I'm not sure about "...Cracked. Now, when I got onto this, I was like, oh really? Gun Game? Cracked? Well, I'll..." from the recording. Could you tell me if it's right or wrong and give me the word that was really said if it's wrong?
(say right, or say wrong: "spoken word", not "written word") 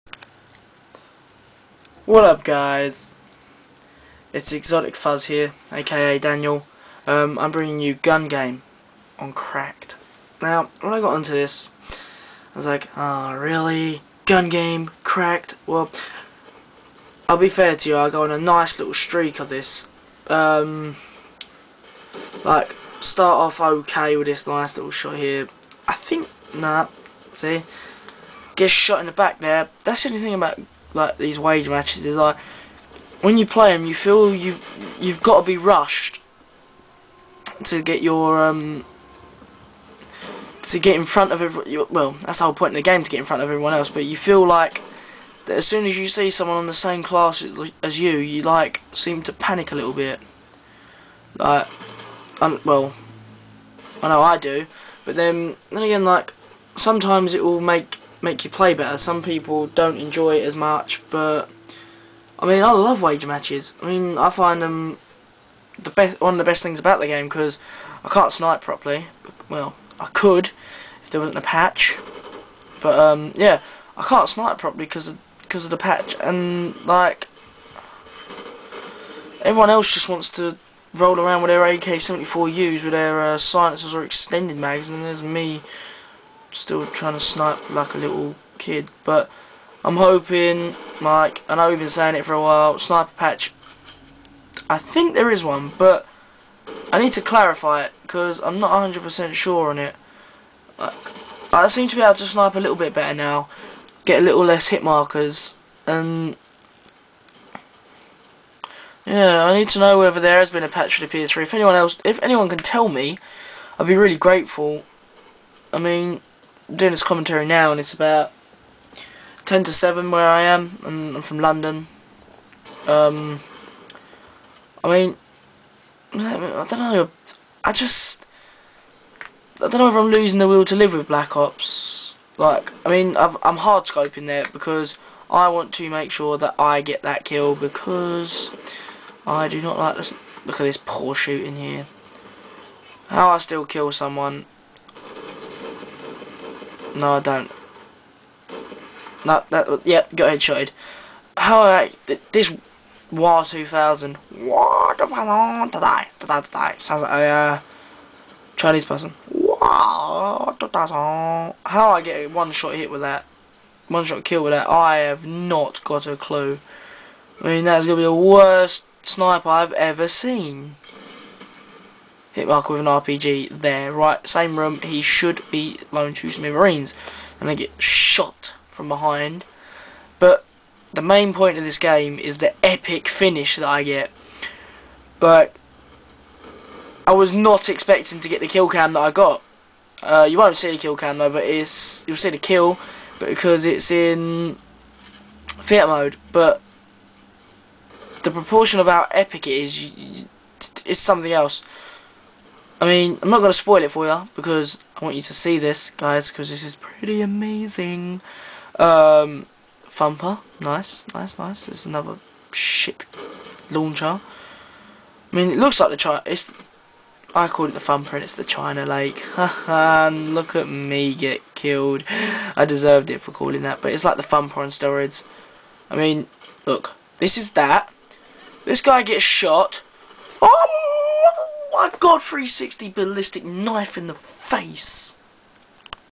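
right.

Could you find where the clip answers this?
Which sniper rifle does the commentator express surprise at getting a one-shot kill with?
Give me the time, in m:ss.
2:33.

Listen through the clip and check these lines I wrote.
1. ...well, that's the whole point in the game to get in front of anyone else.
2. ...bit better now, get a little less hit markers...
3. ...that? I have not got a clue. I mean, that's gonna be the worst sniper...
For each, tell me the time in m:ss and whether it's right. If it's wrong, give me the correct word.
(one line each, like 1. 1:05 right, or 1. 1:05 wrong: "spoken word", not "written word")
1. 0:41 wrong: "everyone", not "anyone"
2. 1:42 right
3. 2:44 right.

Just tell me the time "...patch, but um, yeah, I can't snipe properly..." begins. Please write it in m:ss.
1:11.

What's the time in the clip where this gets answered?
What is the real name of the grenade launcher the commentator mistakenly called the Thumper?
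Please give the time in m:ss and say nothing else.
3:38.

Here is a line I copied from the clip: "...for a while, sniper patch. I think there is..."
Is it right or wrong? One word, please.
right.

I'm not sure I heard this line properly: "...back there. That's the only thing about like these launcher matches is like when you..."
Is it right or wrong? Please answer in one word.
wrong.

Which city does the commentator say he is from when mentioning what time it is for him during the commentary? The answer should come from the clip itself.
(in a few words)
London.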